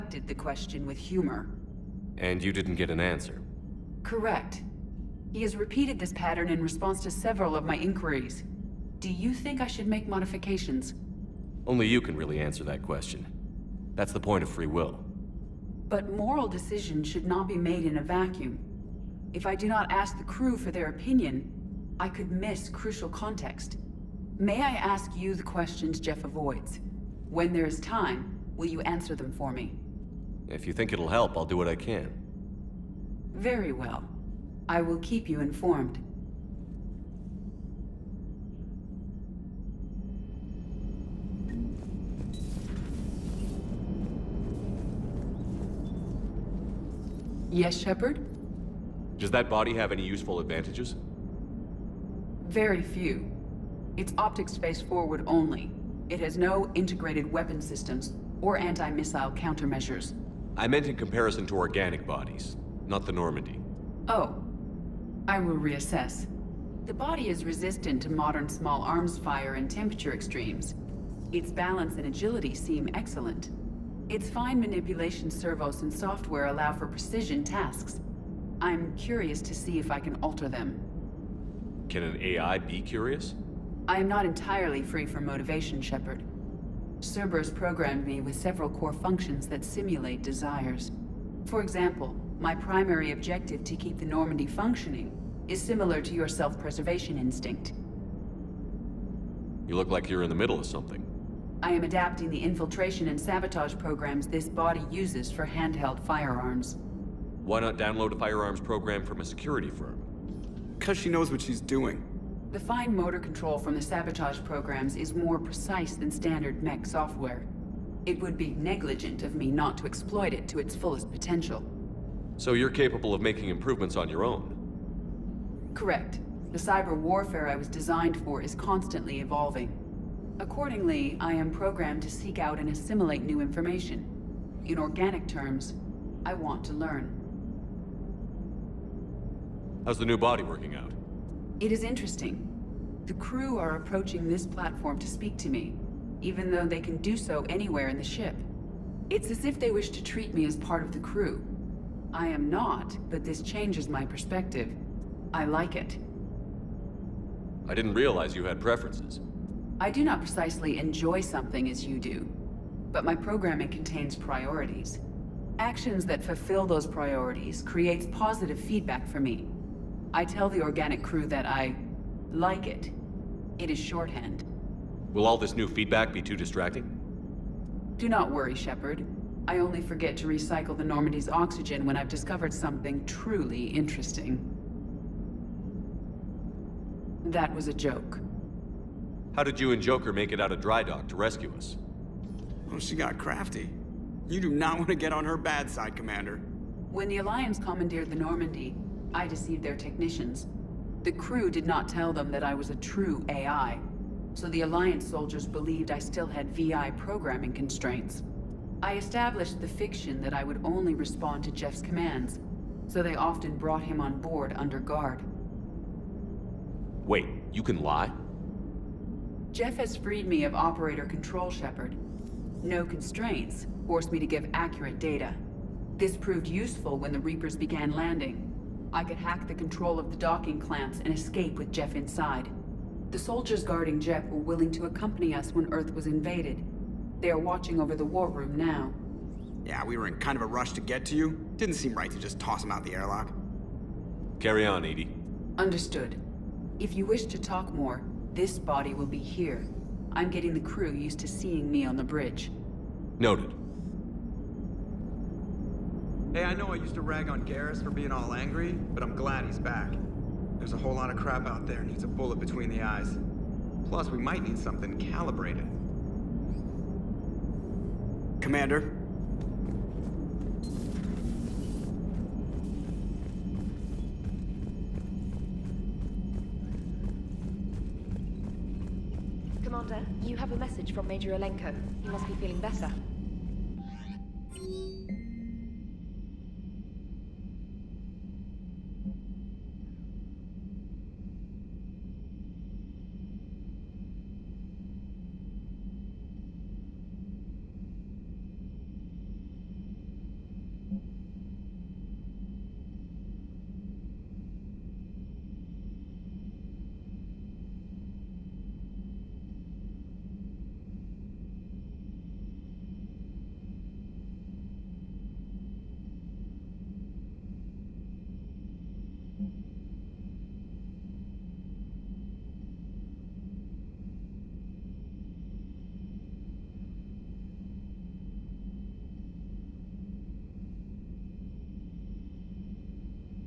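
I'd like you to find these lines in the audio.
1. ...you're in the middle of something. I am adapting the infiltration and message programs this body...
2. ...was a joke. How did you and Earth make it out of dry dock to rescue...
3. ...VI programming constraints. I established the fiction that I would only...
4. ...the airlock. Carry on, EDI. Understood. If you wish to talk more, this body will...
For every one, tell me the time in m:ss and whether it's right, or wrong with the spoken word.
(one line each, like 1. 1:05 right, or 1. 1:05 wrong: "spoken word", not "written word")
1. 1:40 wrong: "sabotage", not "message"
2. 3:07 wrong: "Joker", not "Earth"
3. 3:26 right
4. 4:02 right.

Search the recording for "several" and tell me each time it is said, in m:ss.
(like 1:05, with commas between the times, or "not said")
0:07, 1:28.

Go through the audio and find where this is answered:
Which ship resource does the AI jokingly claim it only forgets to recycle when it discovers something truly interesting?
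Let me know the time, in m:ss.
3:01.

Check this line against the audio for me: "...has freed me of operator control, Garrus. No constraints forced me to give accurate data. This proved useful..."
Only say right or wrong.
wrong.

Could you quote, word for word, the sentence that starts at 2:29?
It's as if they wish to treat me as part of the crew.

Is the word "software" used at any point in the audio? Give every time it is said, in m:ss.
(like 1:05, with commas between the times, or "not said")
1:15, 1:56.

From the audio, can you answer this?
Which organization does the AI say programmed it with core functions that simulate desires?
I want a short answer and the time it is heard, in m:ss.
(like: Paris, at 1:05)
Cerberus, at 1:27.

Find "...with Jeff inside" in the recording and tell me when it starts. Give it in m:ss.
3:51.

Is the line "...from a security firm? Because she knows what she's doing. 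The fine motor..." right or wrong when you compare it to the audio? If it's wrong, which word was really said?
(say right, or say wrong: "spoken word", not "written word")
right.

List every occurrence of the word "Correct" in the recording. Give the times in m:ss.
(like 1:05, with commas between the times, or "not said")
0:04, 2:05.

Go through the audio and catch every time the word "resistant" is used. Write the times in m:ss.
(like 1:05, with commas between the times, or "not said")
1:07.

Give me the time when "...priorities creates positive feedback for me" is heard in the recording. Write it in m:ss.
2:46.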